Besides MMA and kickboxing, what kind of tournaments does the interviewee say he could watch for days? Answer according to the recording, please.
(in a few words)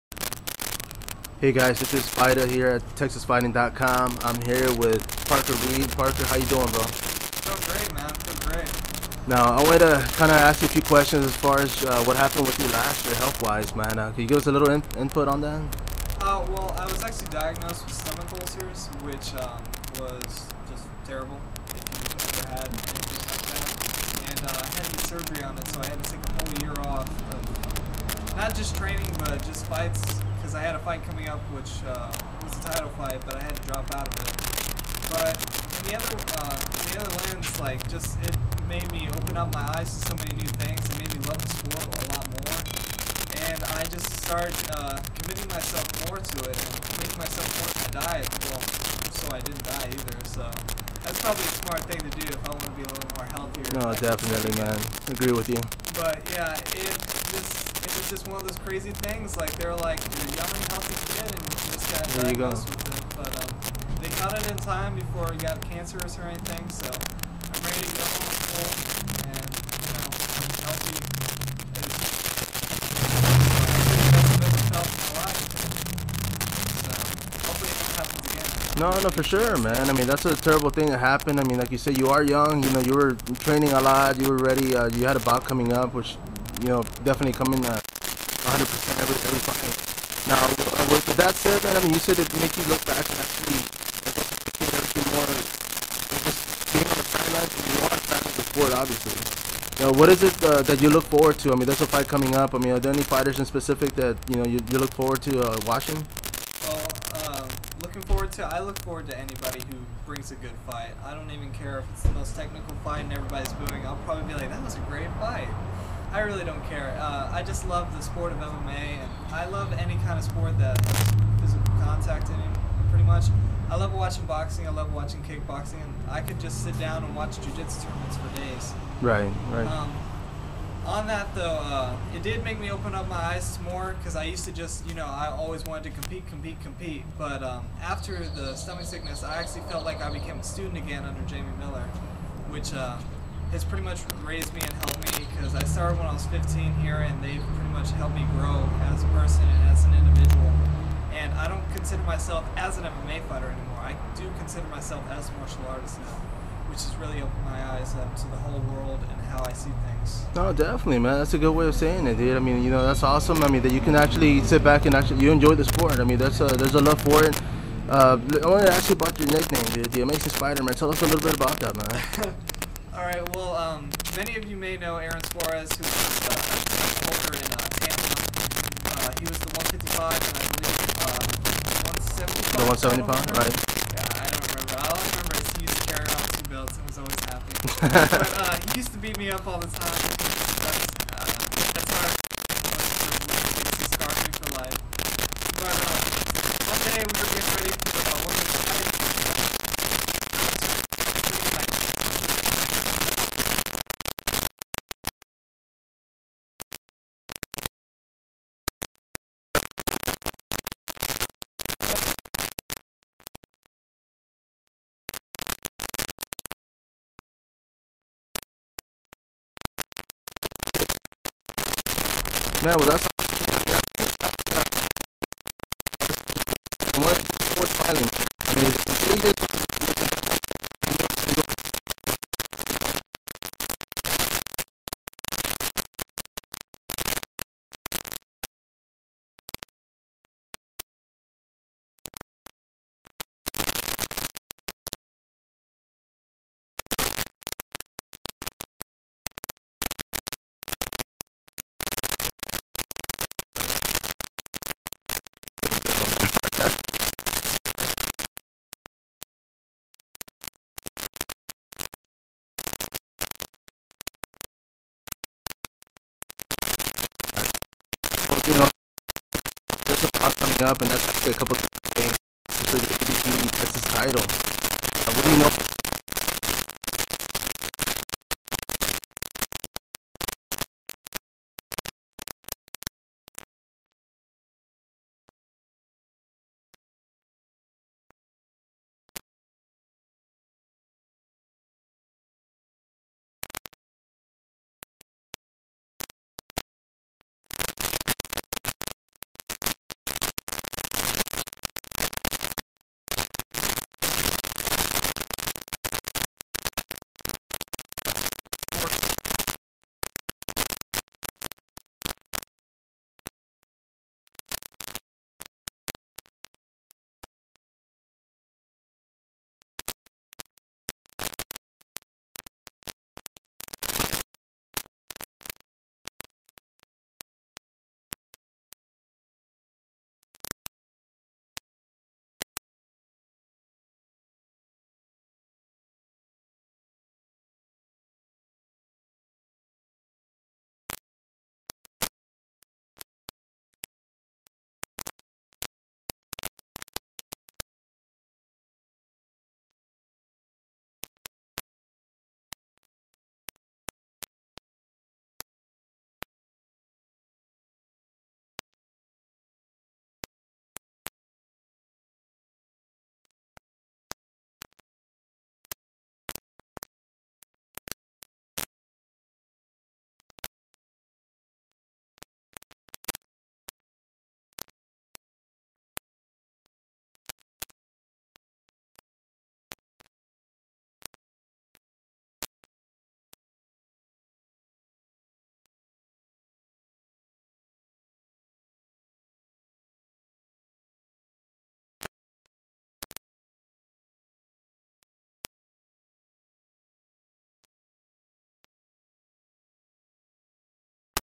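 jujitsu.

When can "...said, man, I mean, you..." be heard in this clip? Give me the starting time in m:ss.
1:31.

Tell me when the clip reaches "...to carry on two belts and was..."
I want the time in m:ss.
3:05.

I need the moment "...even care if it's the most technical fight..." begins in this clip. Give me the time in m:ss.
1:51.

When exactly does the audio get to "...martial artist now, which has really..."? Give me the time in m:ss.
2:35.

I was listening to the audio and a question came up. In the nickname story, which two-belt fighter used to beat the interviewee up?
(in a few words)
Aaron Suarez.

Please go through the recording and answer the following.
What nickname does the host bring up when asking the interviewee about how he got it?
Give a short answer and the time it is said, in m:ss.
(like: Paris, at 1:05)
The Amazing Spider-Man, at 2:49.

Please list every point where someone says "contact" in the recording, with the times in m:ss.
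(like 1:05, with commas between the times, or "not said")
2:01.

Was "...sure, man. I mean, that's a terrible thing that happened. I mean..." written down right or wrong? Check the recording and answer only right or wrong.
right.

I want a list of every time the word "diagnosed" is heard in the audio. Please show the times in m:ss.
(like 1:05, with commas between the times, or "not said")
0:17, 1:02.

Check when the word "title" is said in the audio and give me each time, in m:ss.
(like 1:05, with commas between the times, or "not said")
0:32, 4:33.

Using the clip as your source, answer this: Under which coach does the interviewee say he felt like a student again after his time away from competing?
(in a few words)
Jamie Miller.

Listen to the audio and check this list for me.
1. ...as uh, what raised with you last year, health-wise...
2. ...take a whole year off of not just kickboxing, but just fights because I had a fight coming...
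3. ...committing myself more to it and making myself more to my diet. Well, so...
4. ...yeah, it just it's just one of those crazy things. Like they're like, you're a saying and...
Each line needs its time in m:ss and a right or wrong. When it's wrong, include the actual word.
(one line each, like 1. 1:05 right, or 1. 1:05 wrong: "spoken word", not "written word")
1. 0:11 wrong: "happened", not "raised"
2. 0:26 wrong: "training", not "kickboxing"
3. 0:45 right
4. 0:56 wrong: "young", not "saying".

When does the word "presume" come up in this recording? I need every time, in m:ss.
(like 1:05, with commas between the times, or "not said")
not said.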